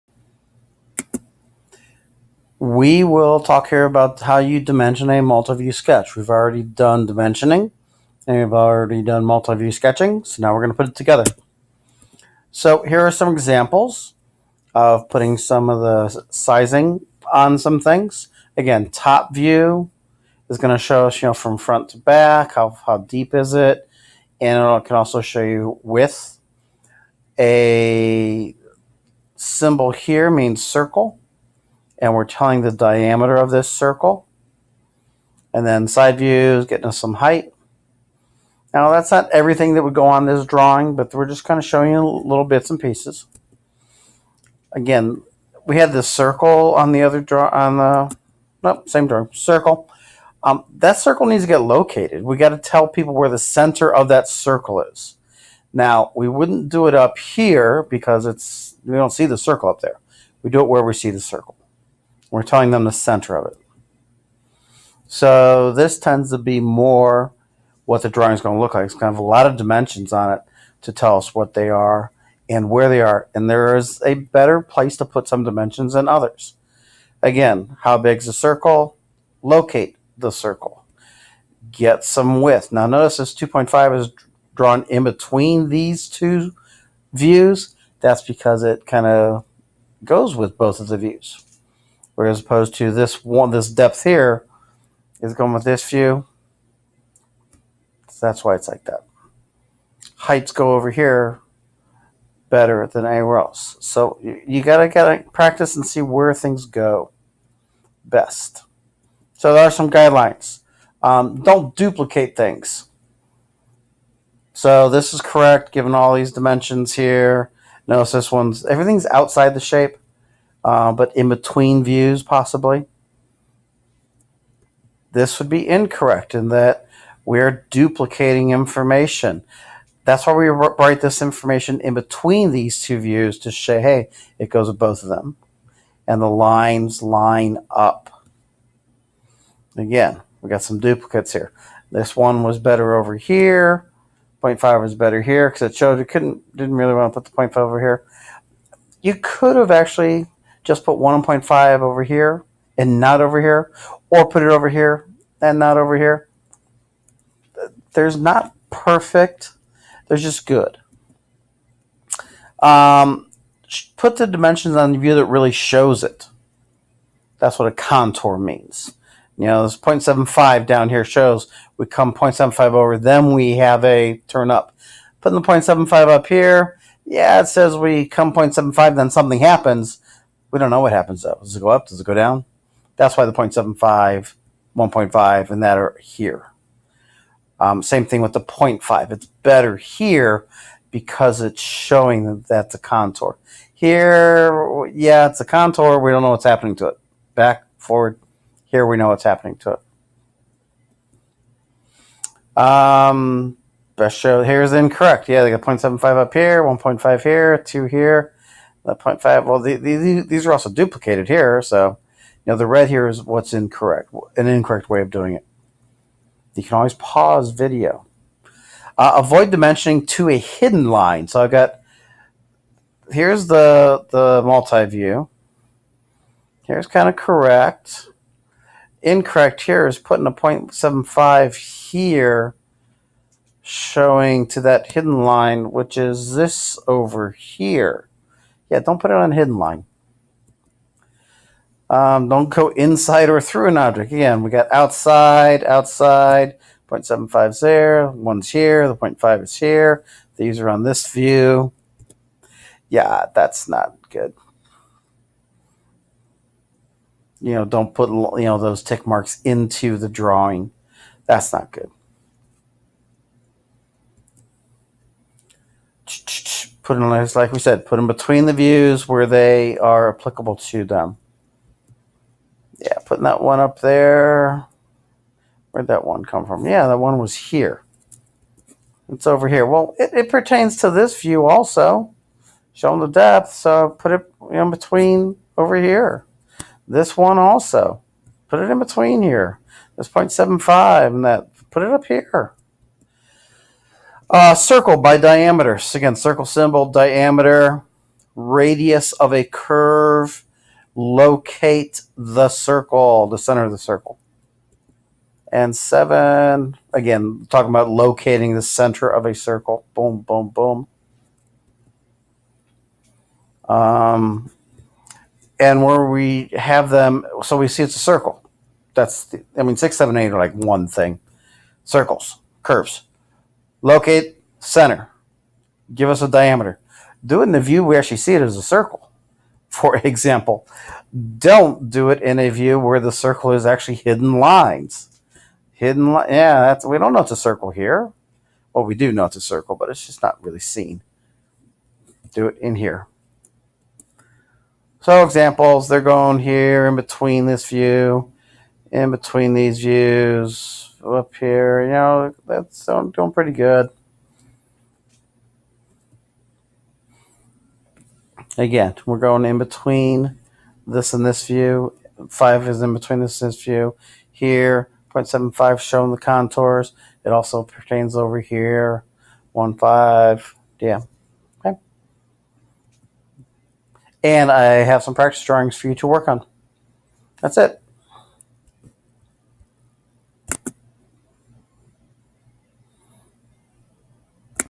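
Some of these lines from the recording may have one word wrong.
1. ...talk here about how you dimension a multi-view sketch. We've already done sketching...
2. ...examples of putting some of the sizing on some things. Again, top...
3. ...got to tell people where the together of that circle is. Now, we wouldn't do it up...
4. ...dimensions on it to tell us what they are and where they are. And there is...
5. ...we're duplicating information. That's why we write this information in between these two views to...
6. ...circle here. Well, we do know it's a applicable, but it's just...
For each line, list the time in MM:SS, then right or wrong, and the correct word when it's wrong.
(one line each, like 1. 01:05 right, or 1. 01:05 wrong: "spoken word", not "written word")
1. 00:03 wrong: "dimensioning", not "sketching"
2. 00:13 right
3. 00:52 wrong: "center", not "together"
4. 01:09 right
5. 02:07 right
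6. 05:37 wrong: "circle", not "applicable".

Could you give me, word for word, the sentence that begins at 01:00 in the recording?
We do it where we see the circle.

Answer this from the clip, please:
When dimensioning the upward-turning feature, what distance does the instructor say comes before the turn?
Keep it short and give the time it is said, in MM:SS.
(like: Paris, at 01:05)
0.75, at 02:49.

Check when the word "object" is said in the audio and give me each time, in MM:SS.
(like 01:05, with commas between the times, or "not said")
04:03.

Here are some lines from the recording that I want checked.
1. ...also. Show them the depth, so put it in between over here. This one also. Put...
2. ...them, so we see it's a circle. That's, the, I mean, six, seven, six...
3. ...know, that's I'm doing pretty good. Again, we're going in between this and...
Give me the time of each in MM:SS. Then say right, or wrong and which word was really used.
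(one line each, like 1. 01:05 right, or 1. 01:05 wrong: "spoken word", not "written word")
1. 04:41 right
2. 05:16 wrong: "eight", not "six"
3. 05:51 right.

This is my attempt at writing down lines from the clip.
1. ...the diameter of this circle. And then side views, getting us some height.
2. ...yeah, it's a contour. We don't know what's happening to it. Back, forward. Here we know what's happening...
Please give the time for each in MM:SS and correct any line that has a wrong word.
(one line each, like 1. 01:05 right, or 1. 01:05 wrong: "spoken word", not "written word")
1. 00:32 right
2. 03:14 right.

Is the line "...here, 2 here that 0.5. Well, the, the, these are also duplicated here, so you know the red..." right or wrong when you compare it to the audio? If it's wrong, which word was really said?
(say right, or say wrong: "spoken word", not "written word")
right.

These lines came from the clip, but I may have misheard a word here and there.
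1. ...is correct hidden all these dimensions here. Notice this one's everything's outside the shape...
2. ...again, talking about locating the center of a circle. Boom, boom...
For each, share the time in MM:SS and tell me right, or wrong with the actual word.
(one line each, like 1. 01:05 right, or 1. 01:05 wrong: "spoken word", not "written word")
1. 01:55 wrong: "given", not "hidden"
2. 05:06 right.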